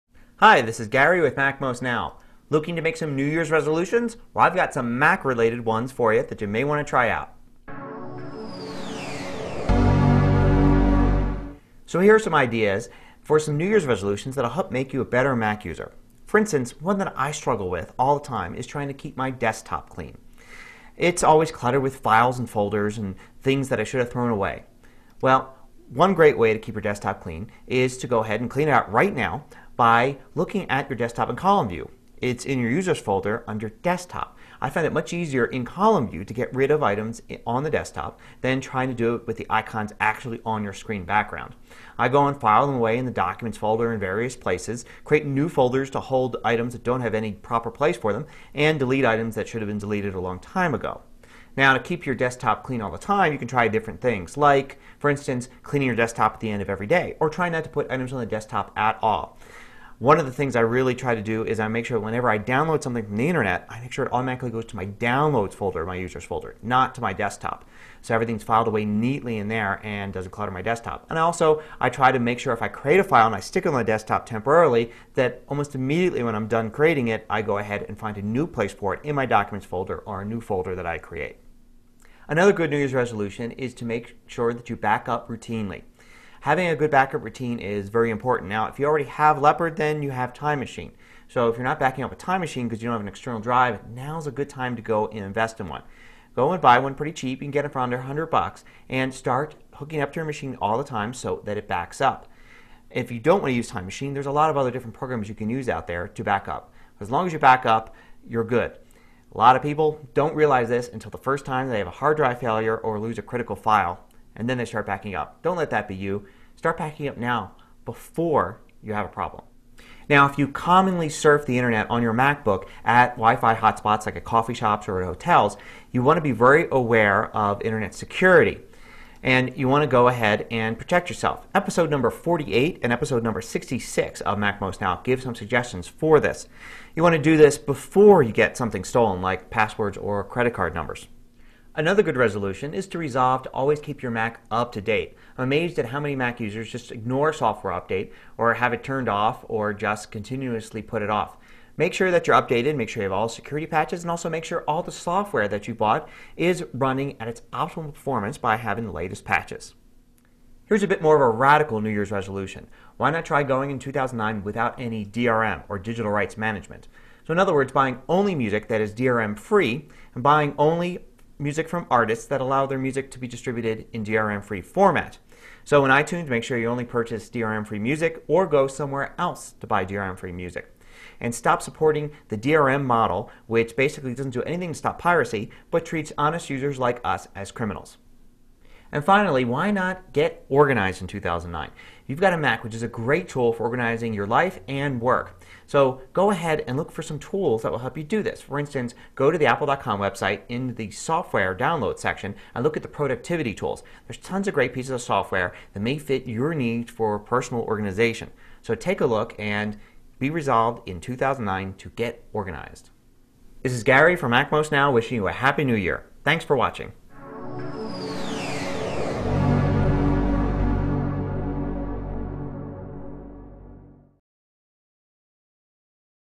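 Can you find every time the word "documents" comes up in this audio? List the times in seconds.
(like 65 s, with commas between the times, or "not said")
43 s, 79 s.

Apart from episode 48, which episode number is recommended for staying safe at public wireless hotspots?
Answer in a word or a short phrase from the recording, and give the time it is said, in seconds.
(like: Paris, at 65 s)
66, at 133 s.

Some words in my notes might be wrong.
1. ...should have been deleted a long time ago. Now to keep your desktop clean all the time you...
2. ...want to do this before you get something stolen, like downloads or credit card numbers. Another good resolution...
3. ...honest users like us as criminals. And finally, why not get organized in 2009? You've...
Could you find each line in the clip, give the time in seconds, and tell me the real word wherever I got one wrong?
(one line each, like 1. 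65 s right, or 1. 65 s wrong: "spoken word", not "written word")
1. 49 s right
2. 137 s wrong: "passwords", not "downloads"
3. 186 s right.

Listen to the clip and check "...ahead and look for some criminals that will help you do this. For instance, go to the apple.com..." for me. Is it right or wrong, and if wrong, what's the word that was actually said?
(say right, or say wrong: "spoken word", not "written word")
wrong: "tools", not "criminals".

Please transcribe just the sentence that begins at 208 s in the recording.
So take a look and be resolved in 2009 to get organized.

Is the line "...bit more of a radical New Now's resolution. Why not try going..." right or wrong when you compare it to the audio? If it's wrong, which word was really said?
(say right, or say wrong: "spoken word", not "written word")
wrong: "Year", not "Now".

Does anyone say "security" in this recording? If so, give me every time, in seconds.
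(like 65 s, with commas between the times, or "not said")
127 s, 153 s.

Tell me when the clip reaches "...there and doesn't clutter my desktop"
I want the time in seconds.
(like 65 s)
69 s.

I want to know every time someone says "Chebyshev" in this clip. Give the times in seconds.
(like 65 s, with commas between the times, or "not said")
not said.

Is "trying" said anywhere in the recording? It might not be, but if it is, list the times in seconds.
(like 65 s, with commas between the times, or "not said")
18 s, 38 s.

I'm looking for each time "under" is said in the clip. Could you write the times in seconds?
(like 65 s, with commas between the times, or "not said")
33 s, 97 s.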